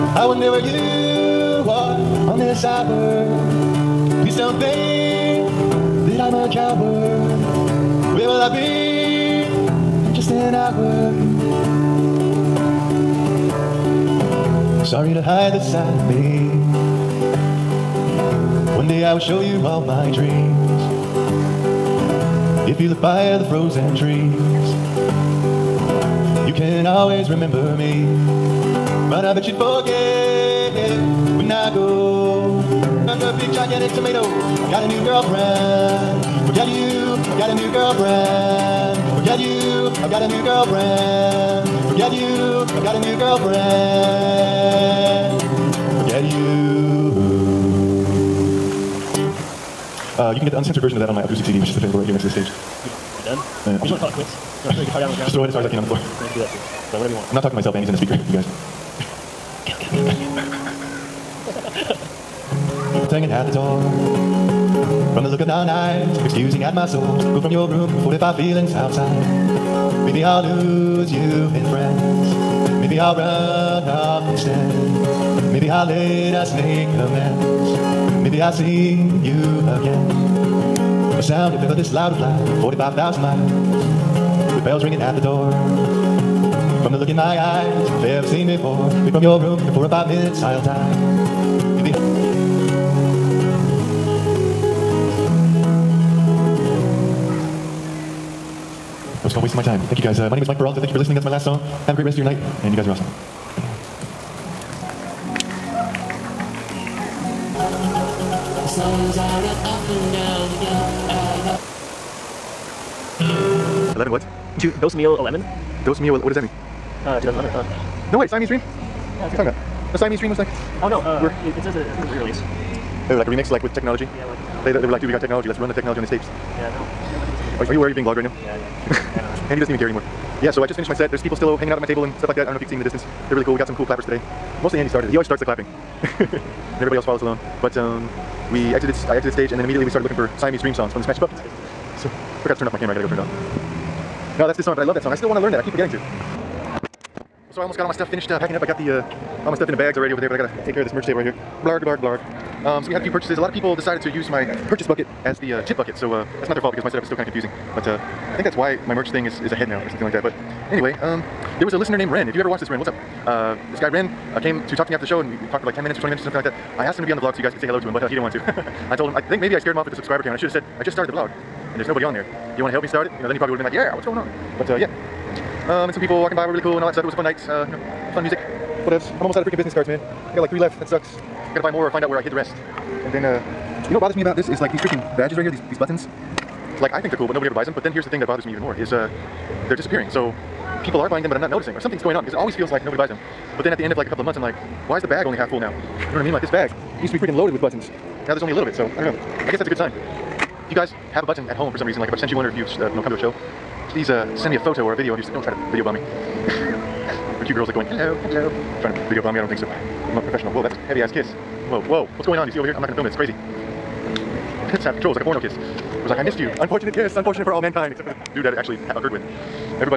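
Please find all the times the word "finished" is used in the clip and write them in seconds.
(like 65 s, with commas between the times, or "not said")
130 s, 148 s.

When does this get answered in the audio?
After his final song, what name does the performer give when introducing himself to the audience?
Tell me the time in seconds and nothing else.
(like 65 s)
100 s.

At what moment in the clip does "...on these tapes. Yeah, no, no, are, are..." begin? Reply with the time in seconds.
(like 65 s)
125 s.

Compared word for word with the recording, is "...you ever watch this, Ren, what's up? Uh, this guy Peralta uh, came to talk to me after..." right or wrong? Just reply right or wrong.
wrong.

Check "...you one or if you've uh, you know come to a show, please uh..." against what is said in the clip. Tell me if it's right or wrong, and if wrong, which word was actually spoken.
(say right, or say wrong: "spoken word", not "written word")
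right.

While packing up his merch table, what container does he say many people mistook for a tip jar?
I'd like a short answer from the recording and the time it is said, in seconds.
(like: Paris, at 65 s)
purchase bucket, at 154 s.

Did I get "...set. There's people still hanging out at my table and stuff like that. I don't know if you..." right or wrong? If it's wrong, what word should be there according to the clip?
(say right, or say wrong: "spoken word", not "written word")
right.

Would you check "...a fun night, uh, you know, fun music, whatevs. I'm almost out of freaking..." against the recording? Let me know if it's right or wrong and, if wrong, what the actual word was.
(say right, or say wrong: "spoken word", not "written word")
right.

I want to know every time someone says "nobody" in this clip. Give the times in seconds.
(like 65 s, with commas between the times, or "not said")
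171 s, 187 s, 192 s.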